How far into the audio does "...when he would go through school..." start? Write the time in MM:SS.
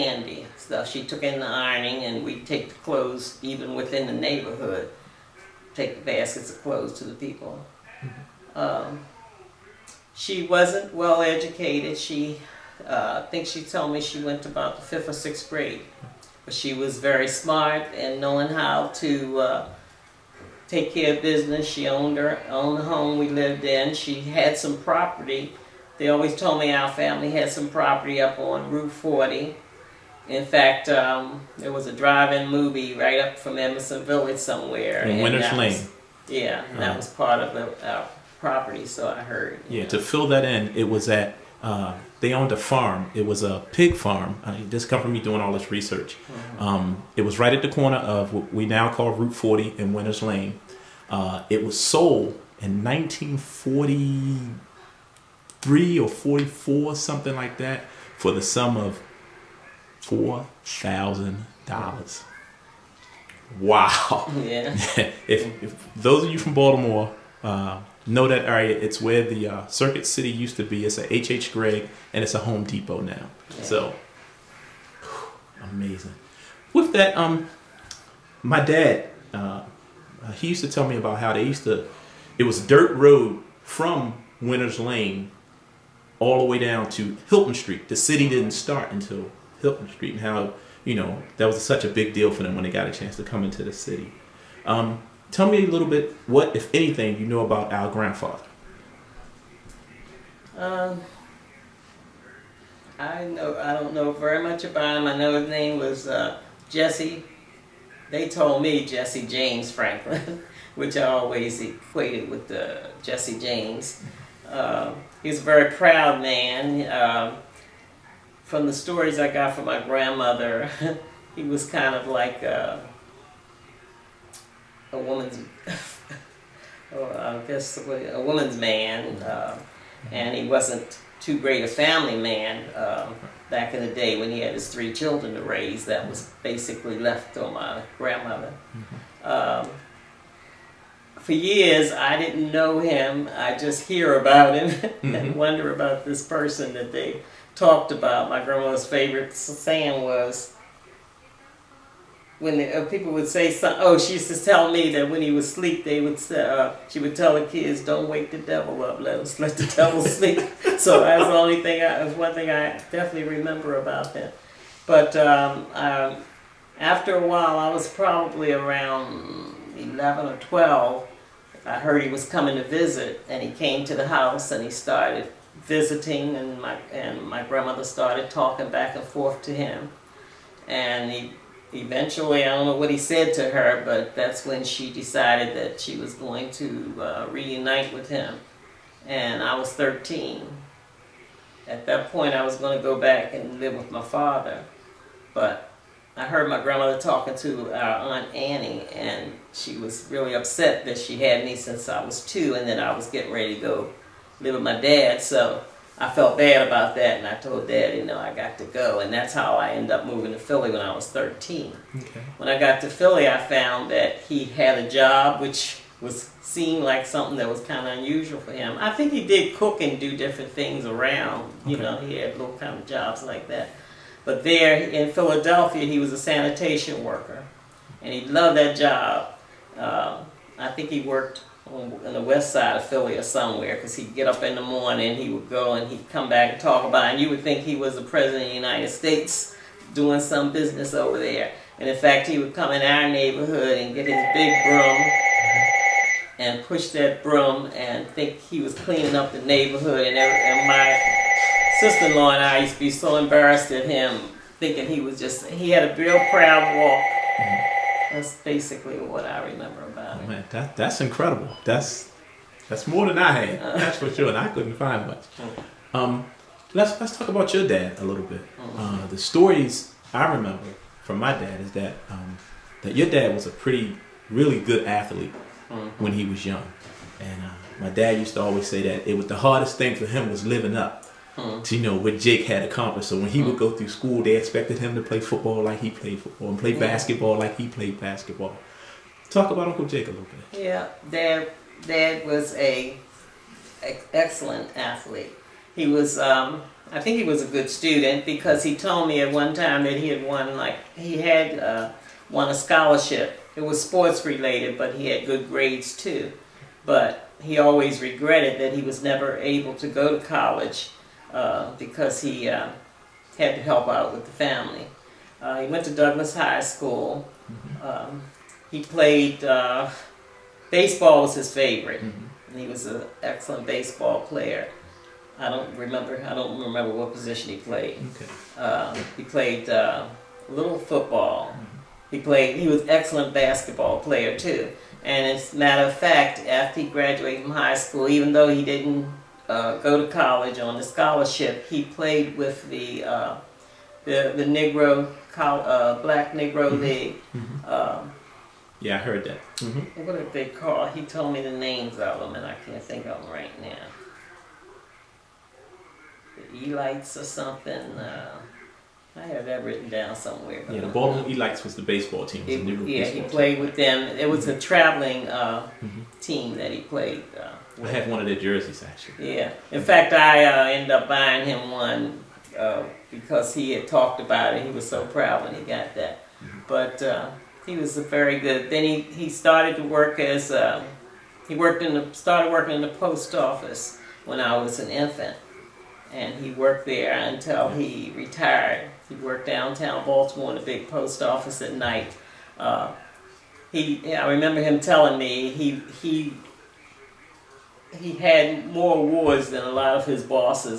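04:43.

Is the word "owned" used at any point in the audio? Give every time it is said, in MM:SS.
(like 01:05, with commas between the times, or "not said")
00:21, 00:42.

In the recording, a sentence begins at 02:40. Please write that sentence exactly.
so that's the only thing, I, that's one thing I definitely remember about him.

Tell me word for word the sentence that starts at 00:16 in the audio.
But she was very smart and knowing how to uh, take care of business.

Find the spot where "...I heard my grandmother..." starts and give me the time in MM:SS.
03:16.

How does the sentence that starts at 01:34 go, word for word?
Um, Tell me a little bit what, if anything, you know about our grandfather.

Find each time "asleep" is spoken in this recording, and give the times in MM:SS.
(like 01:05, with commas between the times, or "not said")
02:35.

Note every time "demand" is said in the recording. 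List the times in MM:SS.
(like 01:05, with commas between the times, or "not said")
not said.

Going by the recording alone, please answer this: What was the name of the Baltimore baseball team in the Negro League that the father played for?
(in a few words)
Baltimore Elites.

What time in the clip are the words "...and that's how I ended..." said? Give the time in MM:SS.
03:28.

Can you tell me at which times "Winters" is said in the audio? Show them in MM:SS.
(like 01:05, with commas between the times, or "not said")
00:35, 00:49, 01:24.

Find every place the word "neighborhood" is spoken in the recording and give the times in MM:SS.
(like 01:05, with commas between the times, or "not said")
00:04, 04:03, 04:09.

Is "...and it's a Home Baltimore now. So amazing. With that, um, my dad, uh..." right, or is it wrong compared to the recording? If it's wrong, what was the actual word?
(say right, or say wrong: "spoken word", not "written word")
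wrong: "Depot", not "Baltimore".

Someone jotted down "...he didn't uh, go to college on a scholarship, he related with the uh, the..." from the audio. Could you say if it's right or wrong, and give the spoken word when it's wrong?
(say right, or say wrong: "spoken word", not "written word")
wrong: "played", not "related".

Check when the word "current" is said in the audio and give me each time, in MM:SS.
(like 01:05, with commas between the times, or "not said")
not said.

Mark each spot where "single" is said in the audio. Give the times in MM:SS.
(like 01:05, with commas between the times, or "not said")
not said.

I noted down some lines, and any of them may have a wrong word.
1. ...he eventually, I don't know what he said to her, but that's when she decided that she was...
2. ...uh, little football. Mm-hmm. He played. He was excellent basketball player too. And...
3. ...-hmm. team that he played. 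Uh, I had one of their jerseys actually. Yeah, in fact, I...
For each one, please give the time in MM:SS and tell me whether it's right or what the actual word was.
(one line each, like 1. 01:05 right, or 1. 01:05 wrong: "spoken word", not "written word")
1. 03:01 right
2. 05:29 right
3. 06:05 right.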